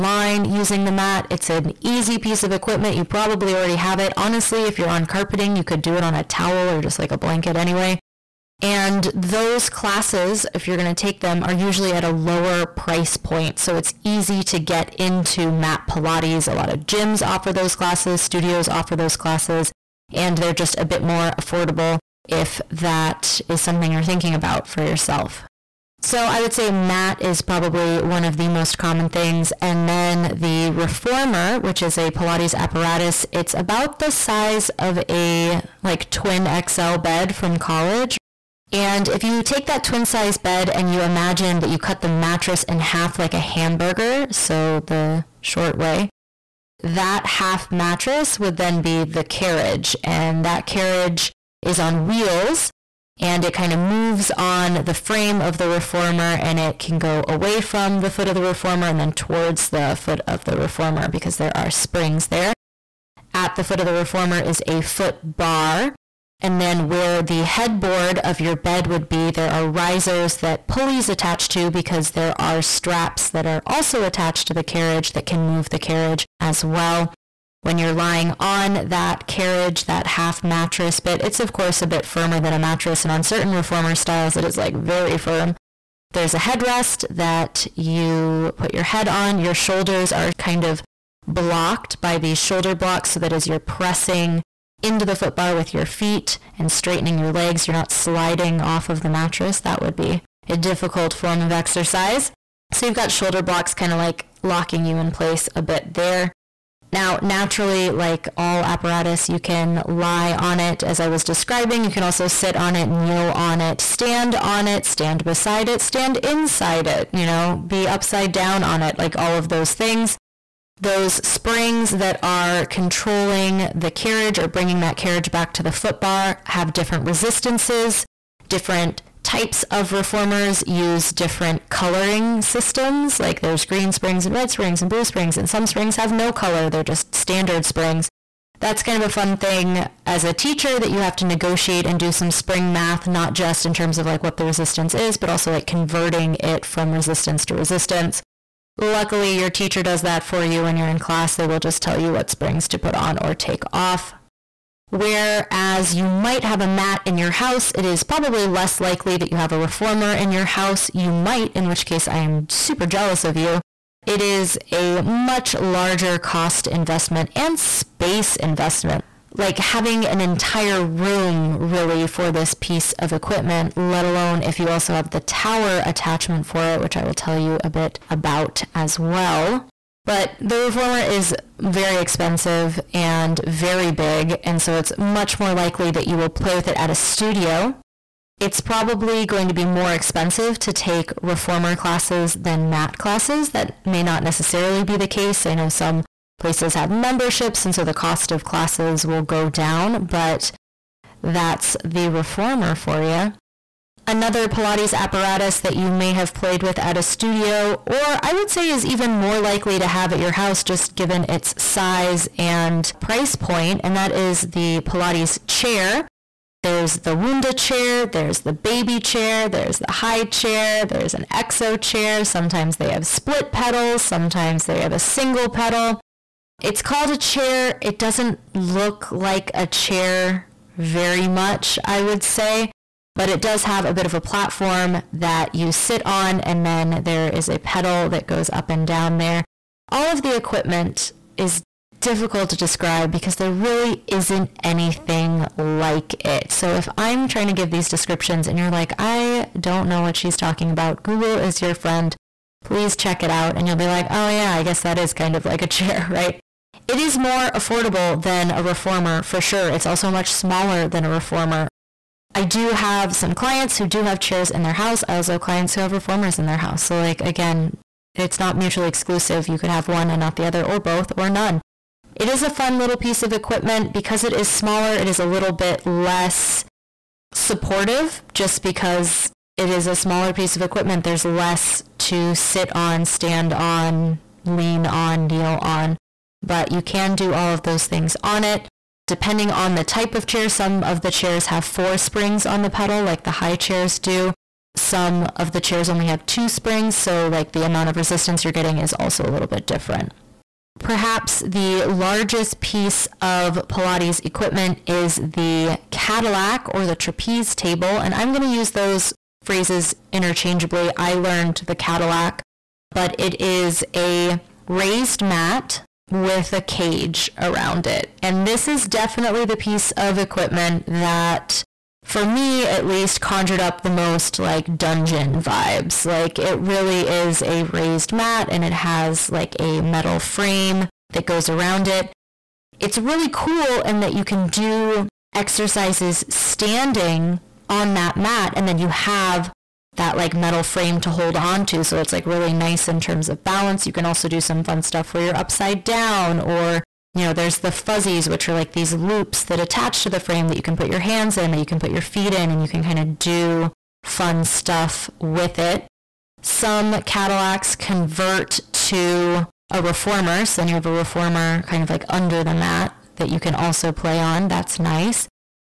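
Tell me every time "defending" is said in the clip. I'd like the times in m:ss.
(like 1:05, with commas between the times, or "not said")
not said.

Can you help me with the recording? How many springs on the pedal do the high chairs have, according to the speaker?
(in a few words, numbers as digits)
4.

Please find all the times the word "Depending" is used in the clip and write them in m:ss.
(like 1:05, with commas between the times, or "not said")
4:49.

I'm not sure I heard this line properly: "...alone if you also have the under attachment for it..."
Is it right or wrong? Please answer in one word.
wrong.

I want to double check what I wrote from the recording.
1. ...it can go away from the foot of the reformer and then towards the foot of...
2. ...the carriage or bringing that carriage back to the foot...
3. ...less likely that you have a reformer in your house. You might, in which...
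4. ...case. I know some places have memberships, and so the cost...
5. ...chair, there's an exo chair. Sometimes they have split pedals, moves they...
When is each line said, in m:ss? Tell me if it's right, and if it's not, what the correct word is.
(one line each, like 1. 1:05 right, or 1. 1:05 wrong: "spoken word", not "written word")
1. 0:56 right
2. 2:03 right
3. 2:38 right
4. 3:15 right
5. 3:40 wrong: "sometimes", not "moves".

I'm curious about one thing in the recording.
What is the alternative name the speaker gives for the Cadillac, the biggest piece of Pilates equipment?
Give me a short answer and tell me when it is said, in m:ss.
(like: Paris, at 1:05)
Trapeze table, at 5:06.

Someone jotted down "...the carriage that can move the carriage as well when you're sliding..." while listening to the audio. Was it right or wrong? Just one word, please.
wrong.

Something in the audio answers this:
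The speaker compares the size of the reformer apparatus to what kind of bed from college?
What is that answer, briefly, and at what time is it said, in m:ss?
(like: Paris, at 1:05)
Twin XL bed, at 0:36.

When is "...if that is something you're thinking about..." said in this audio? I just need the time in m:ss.
0:22.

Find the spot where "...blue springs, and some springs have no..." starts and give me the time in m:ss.
2:14.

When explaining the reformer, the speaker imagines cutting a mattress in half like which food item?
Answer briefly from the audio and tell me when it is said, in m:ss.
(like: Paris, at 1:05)
Hamburger, at 0:43.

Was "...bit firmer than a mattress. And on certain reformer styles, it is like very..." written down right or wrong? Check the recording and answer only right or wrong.
right.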